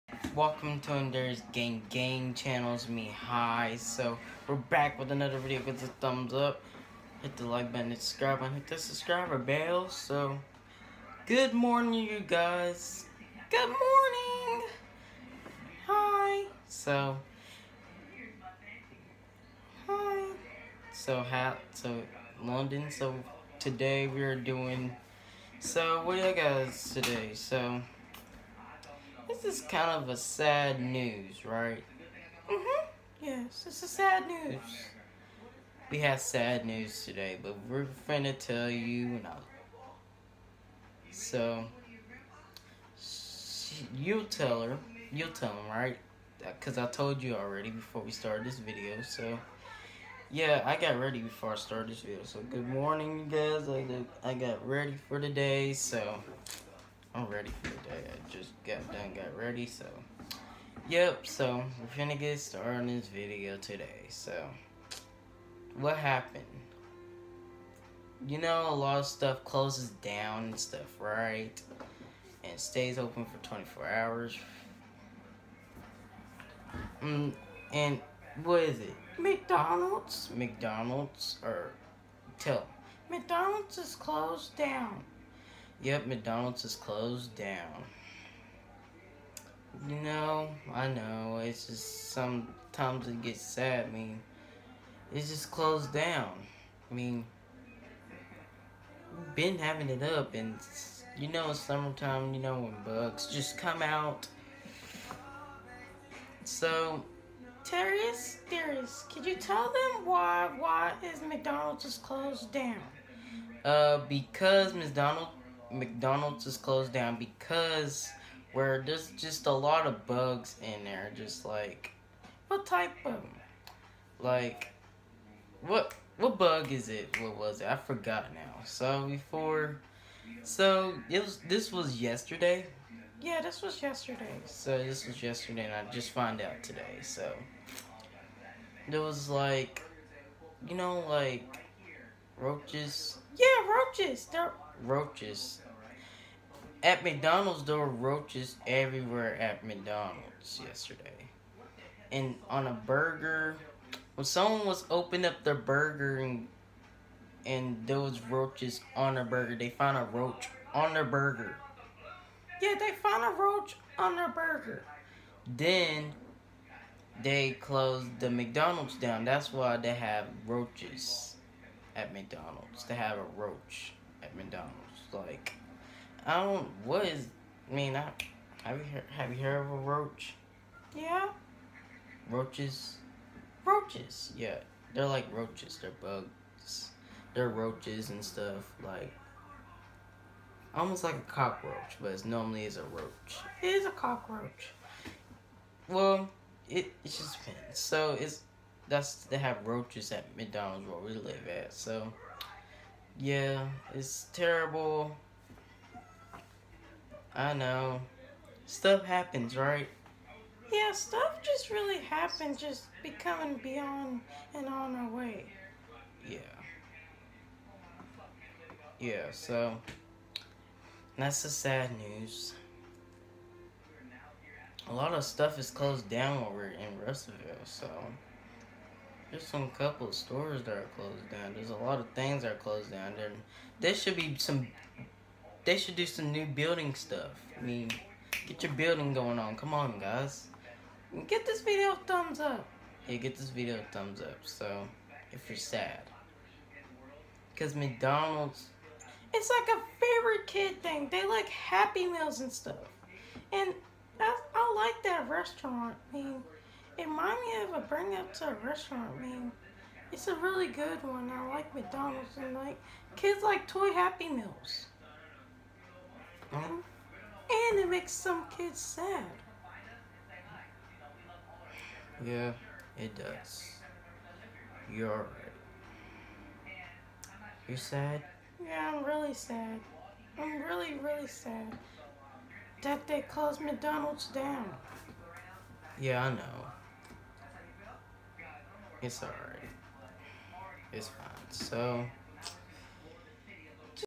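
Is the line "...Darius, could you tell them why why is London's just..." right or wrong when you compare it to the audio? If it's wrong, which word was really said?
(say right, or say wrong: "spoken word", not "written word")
wrong: "McDonald", not "London".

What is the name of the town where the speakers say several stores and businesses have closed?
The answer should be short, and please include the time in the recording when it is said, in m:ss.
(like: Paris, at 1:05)
Russellville, at 3:47.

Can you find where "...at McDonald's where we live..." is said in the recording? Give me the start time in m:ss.
3:20.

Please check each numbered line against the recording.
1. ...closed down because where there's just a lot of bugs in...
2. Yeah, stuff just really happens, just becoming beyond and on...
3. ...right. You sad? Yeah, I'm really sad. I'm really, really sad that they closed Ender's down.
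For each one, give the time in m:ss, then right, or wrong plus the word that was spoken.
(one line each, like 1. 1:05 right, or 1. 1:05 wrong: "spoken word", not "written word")
1. 1:56 right
2. 3:30 right
3. 4:35 wrong: "McDonald", not "Ender".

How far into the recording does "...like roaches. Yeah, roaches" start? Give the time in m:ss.
2:21.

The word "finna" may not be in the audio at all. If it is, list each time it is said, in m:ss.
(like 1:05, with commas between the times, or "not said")
0:38, 1:02.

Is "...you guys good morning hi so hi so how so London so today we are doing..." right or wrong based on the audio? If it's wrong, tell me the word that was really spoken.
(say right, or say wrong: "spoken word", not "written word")
right.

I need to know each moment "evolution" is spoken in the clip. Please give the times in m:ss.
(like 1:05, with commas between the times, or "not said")
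not said.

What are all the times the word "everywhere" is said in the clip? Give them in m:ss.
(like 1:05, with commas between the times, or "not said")
2:28.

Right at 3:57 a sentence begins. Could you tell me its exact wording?
I mean, get your building going on.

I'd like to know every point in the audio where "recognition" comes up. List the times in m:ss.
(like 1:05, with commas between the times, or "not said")
not said.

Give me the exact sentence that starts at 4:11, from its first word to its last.
They like Happy Meals and stuff.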